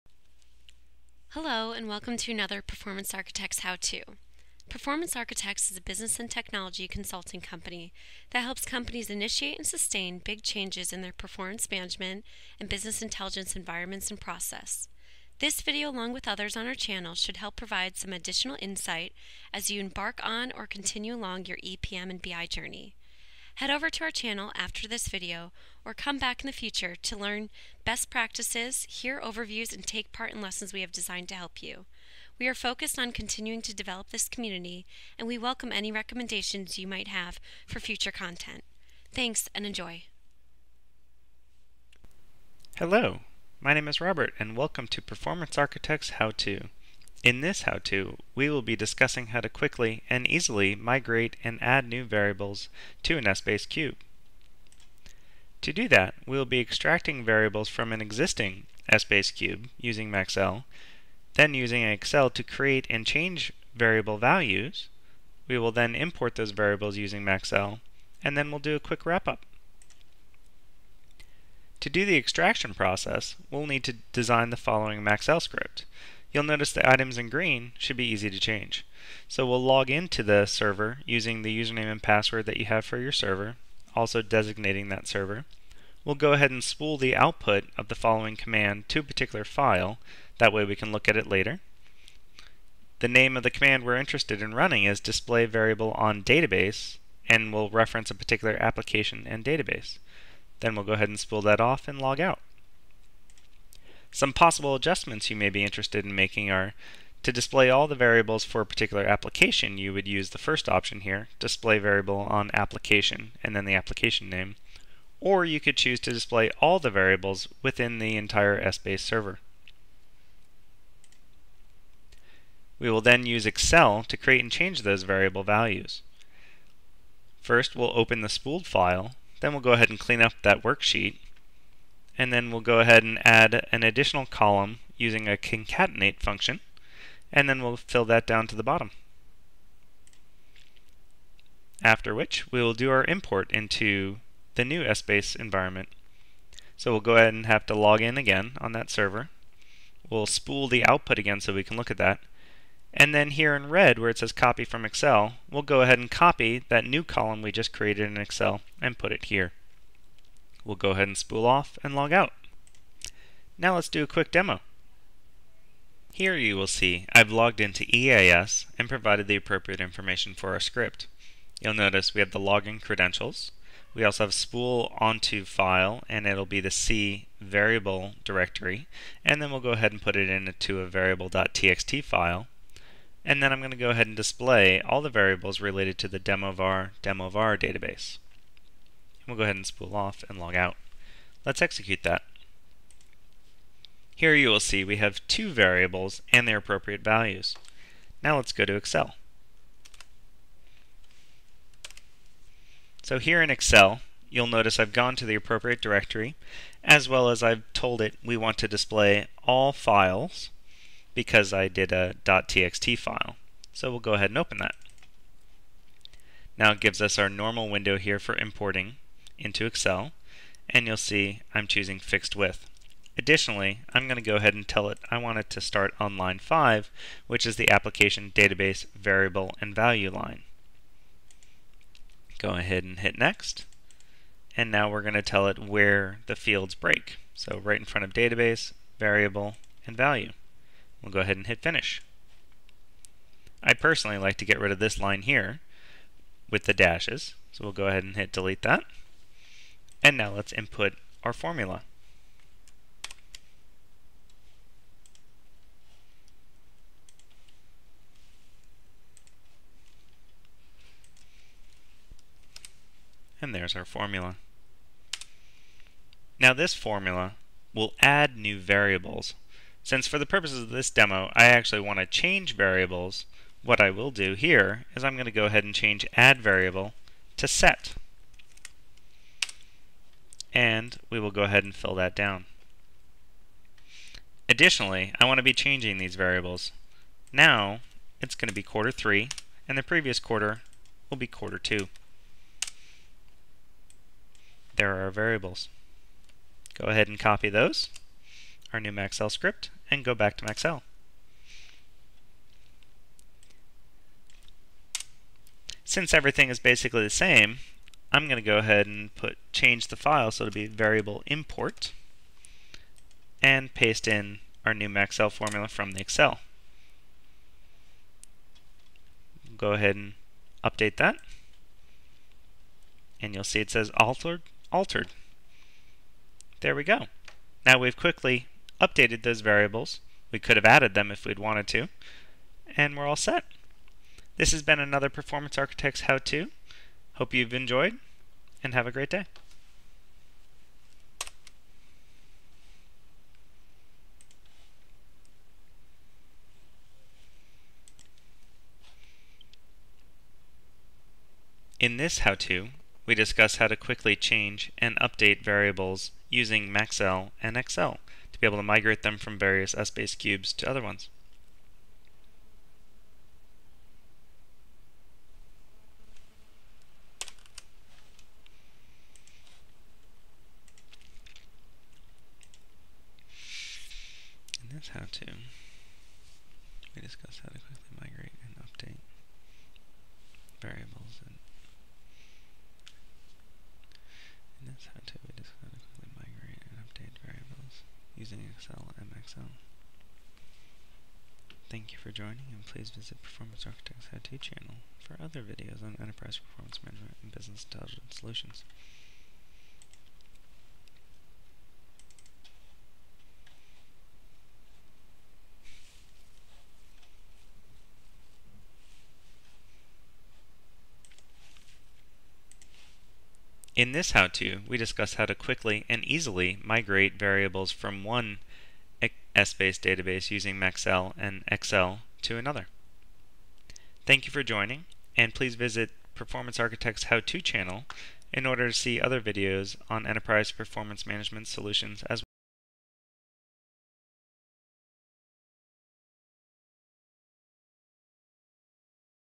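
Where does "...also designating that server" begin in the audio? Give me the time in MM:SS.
01:23.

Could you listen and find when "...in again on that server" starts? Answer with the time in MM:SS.
02:28.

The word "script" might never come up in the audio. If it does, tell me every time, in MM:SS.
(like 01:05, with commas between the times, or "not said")
01:15, 02:50, 04:59.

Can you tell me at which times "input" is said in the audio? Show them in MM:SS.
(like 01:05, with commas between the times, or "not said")
04:10.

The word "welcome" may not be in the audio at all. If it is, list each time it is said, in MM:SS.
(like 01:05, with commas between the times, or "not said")
00:01, 00:35, 00:44.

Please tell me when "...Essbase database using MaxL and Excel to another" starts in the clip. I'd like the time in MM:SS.
06:59.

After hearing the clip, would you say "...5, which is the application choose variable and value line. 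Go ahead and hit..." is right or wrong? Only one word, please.
wrong.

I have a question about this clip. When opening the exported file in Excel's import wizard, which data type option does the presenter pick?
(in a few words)
fixed width.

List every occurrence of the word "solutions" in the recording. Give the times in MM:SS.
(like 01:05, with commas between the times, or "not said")
06:38, 07:11.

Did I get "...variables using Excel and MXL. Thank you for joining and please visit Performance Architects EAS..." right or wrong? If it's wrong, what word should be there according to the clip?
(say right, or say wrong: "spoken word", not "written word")
wrong: "How", not "EAS".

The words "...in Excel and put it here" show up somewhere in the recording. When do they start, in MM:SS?
02:38.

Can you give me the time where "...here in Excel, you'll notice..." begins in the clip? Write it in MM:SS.
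03:23.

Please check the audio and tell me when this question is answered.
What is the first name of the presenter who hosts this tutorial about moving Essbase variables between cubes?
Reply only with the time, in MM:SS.
00:44.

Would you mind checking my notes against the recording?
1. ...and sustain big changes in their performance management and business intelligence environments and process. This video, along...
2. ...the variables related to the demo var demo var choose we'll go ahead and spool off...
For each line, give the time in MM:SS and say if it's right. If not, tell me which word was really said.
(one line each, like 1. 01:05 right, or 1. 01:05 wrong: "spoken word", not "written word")
1. 00:09 right
2. 03:05 wrong: "database", not "choose".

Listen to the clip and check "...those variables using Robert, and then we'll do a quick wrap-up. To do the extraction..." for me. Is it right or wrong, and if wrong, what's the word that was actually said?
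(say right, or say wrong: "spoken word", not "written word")
wrong: "MaxL", not "Robert".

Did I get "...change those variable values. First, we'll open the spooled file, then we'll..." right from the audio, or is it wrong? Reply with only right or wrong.
right.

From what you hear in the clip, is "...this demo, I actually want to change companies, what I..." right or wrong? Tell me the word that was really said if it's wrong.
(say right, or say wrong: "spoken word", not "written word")
wrong: "variables", not "companies".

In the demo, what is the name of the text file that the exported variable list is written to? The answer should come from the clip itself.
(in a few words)
variable.txt.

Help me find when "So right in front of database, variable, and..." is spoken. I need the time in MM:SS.
03:57.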